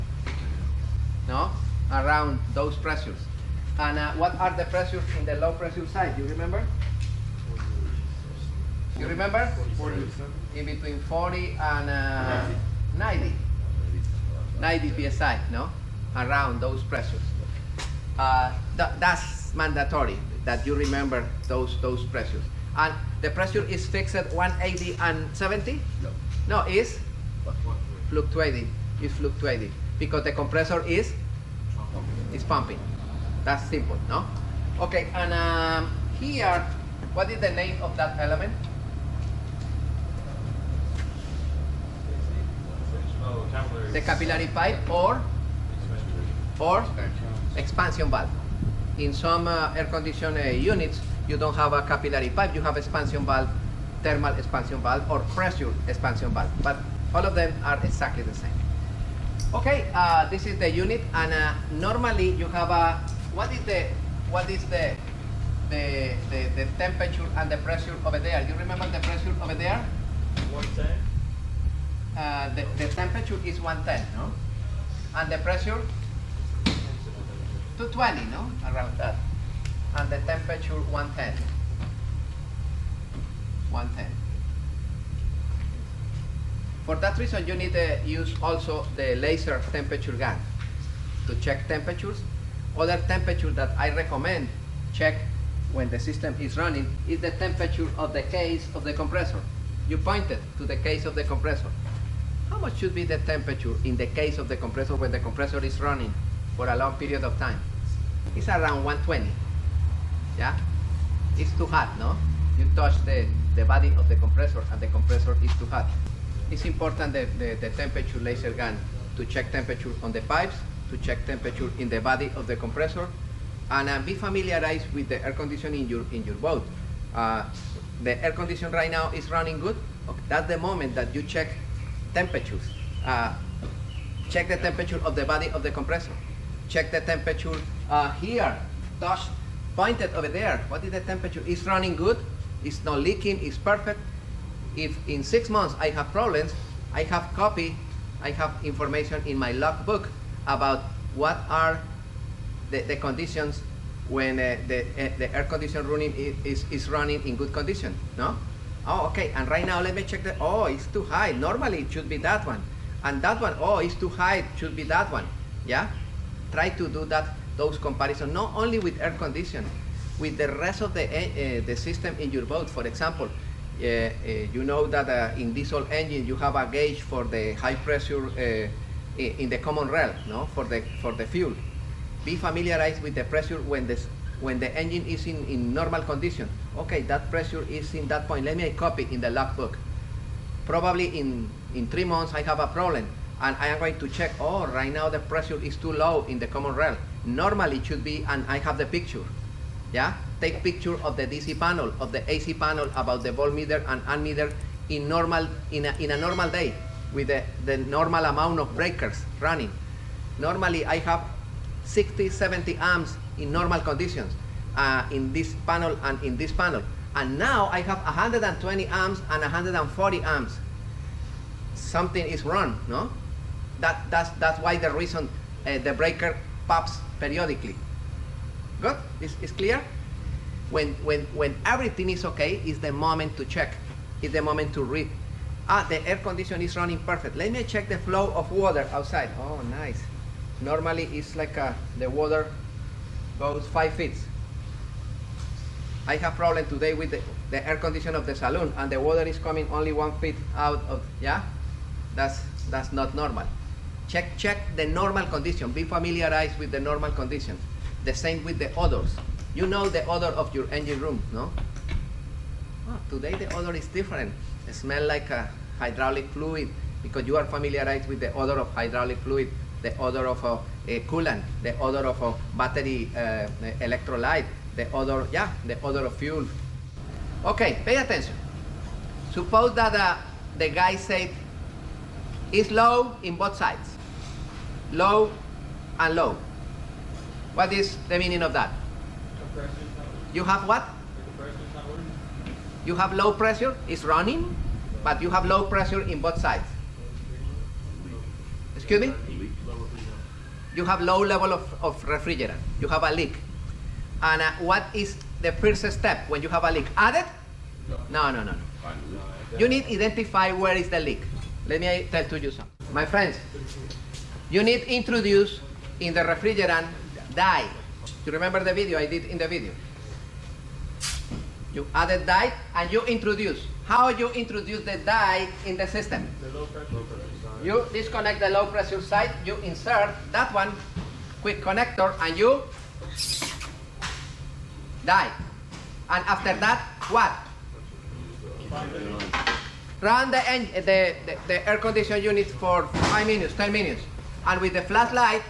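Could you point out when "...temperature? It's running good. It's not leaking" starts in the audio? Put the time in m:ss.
2:21.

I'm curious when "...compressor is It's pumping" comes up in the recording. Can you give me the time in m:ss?
0:30.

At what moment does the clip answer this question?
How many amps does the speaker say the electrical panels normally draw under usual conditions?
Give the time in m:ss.
3:31.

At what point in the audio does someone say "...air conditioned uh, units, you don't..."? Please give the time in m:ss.
0:49.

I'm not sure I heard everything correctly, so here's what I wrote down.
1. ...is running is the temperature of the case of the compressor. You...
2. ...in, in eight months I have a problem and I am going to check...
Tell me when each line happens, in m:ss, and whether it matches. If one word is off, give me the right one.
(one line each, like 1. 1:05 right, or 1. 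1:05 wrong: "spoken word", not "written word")
1. 1:36 right
2. 3:11 wrong: "three", not "eight".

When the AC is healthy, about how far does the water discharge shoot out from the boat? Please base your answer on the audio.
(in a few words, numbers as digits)
5 feet.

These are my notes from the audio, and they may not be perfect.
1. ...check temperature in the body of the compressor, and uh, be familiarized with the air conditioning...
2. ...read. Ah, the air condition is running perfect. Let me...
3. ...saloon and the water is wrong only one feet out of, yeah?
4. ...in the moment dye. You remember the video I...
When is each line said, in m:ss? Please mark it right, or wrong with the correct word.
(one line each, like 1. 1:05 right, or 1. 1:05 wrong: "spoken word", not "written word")
1. 2:00 right
2. 3:54 right
3. 4:08 wrong: "coming", not "wrong"
4. 5:16 wrong: "refrigerant", not "moment".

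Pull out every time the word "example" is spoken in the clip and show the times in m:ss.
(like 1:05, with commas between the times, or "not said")
2:52.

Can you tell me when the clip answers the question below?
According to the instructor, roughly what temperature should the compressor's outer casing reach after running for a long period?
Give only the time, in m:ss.
1:48.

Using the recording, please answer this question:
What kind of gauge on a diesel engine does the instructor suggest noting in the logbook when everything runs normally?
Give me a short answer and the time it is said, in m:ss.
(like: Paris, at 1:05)
high pressure in the common rail, at 2:57.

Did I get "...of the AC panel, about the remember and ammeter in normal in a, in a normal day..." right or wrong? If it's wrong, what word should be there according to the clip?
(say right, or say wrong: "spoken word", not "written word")
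wrong: "voltmeter", not "remember".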